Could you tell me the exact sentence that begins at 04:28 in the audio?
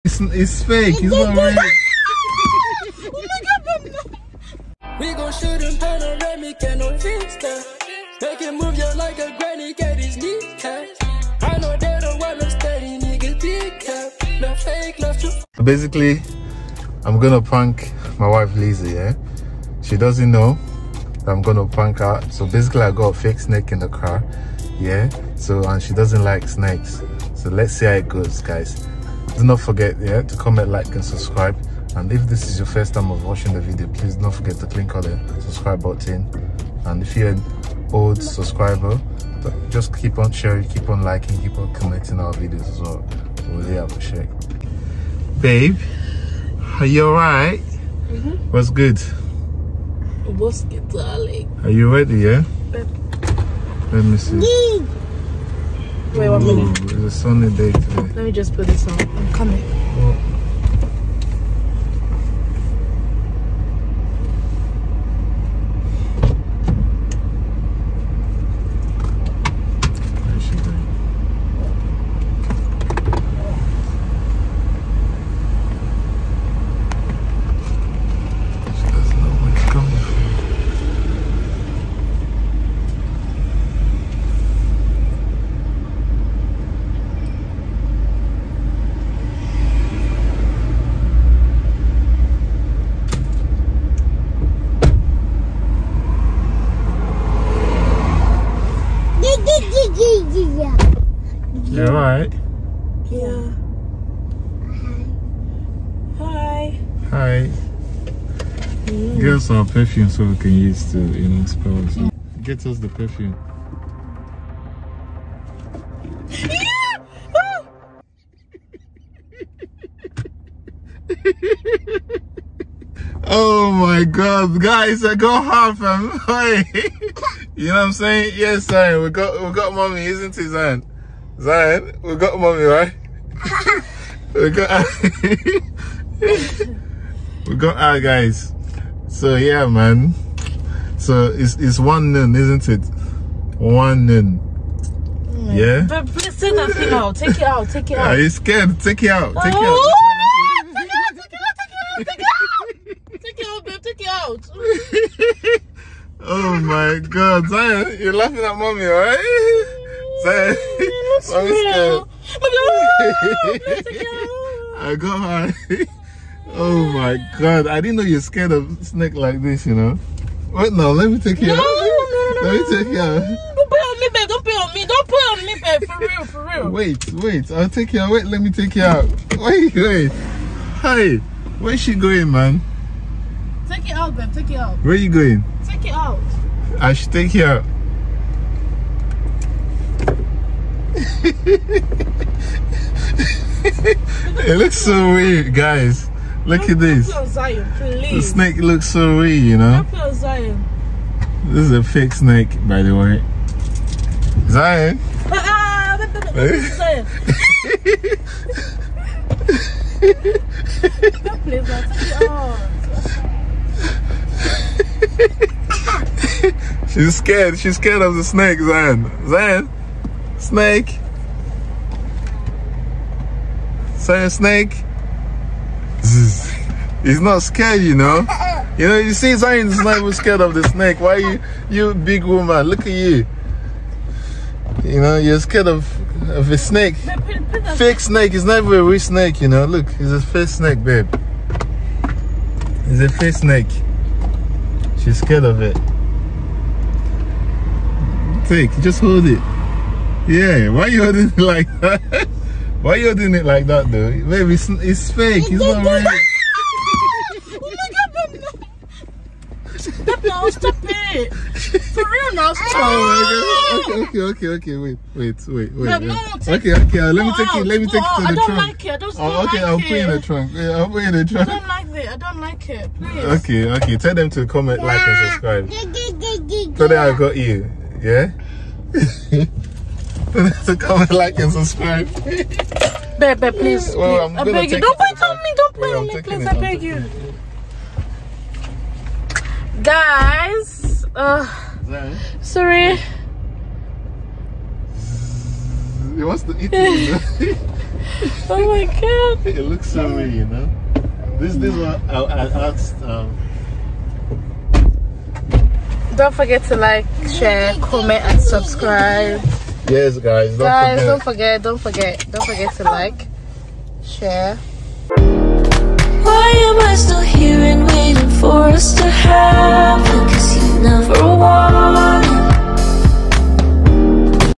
I don't, oh, don't okay, like I'll it.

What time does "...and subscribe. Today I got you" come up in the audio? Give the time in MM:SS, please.
04:35.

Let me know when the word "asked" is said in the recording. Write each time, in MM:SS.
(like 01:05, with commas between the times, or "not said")
05:02.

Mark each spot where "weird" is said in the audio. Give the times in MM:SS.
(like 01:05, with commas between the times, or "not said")
03:15, 03:19, 05:00.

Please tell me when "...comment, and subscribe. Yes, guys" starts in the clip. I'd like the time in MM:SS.
05:07.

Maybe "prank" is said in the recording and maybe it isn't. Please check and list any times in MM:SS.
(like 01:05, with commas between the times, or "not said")
00:17, 00:21.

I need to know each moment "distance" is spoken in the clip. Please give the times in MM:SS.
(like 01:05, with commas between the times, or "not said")
not said.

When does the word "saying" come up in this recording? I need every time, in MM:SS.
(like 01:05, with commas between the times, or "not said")
02:07.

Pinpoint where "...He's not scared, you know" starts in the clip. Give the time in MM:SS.
03:47.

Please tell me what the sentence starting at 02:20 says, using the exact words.
So it's it's one noon, isn't it?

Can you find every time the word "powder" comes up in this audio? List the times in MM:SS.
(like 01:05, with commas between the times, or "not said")
not said.